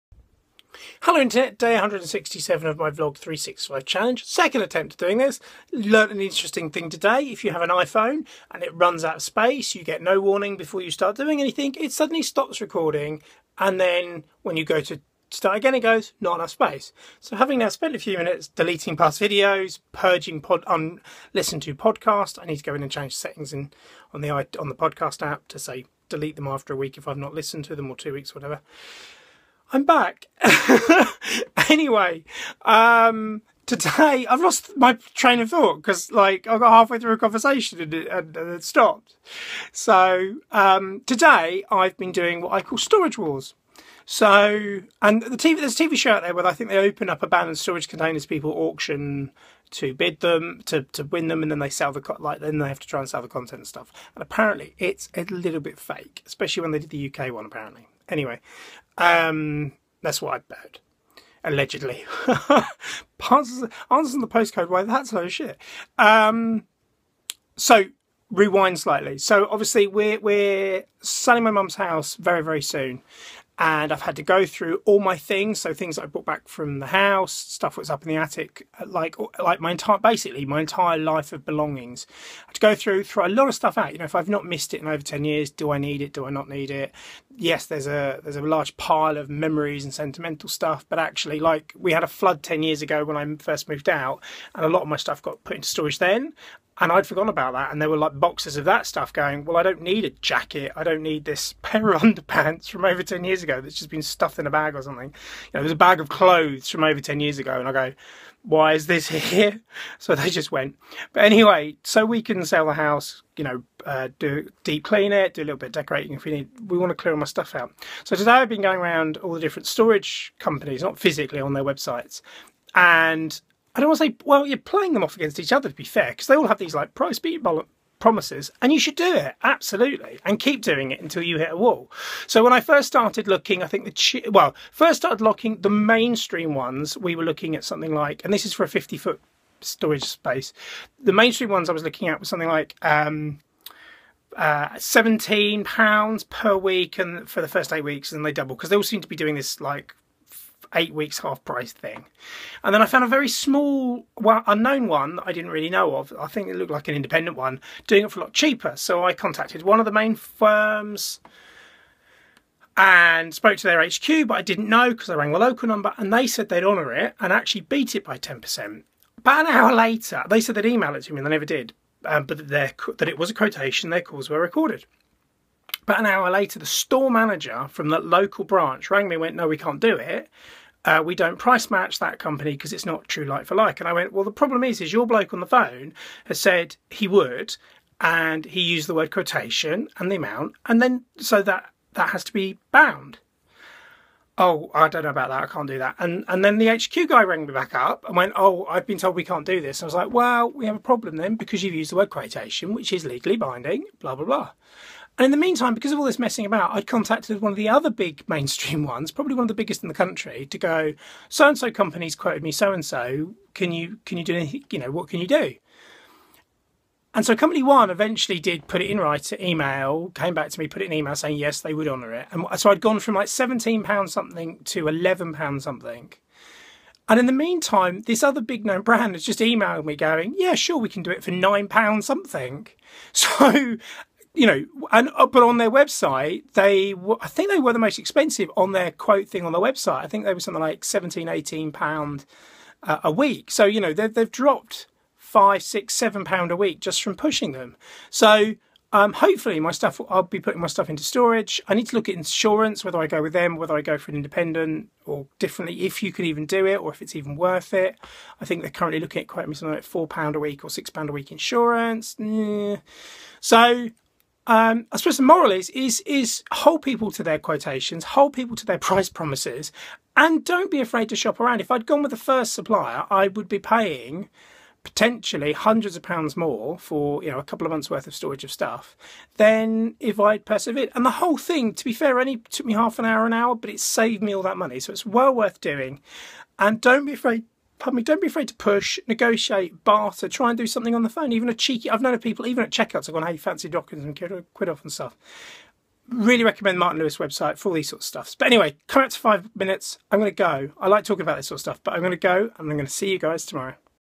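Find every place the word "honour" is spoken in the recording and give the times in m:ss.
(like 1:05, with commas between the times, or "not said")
2:46, 3:41.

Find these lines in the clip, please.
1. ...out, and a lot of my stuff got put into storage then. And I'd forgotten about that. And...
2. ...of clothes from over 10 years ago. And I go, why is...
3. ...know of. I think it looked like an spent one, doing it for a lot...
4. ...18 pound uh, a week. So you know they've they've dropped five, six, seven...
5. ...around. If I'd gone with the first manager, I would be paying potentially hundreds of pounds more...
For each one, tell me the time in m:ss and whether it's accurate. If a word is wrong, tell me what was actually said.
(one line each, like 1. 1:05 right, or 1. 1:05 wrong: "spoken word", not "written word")
1. 1:33 right
2. 1:45 right
3. 2:35 wrong: "independent", not "spent"
4. 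4:01 right
5. 4:31 wrong: "supplier", not "manager".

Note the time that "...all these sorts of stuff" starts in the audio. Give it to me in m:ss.
4:57.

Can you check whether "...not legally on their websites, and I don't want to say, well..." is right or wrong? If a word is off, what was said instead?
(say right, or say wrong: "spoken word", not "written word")
wrong: "physically", not "legally".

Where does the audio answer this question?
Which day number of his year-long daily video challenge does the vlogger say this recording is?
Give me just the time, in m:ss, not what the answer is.
0:01.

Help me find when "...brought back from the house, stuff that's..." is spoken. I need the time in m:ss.
1:16.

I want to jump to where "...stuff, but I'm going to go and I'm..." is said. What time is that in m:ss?
5:01.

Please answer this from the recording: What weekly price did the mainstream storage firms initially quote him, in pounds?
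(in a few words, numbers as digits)
17 pounds.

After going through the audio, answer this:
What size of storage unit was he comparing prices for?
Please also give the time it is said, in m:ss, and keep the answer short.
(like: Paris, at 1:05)
50 foot, at 2:18.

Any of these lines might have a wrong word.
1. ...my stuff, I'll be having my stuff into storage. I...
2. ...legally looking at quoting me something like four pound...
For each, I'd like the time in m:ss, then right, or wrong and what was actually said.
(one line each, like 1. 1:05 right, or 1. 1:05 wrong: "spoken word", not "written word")
1. 4:09 wrong: "putting", not "having"
2. 4:18 wrong: "currently", not "legally".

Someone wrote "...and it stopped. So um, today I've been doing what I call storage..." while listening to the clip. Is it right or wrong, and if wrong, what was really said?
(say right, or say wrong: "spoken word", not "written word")
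right.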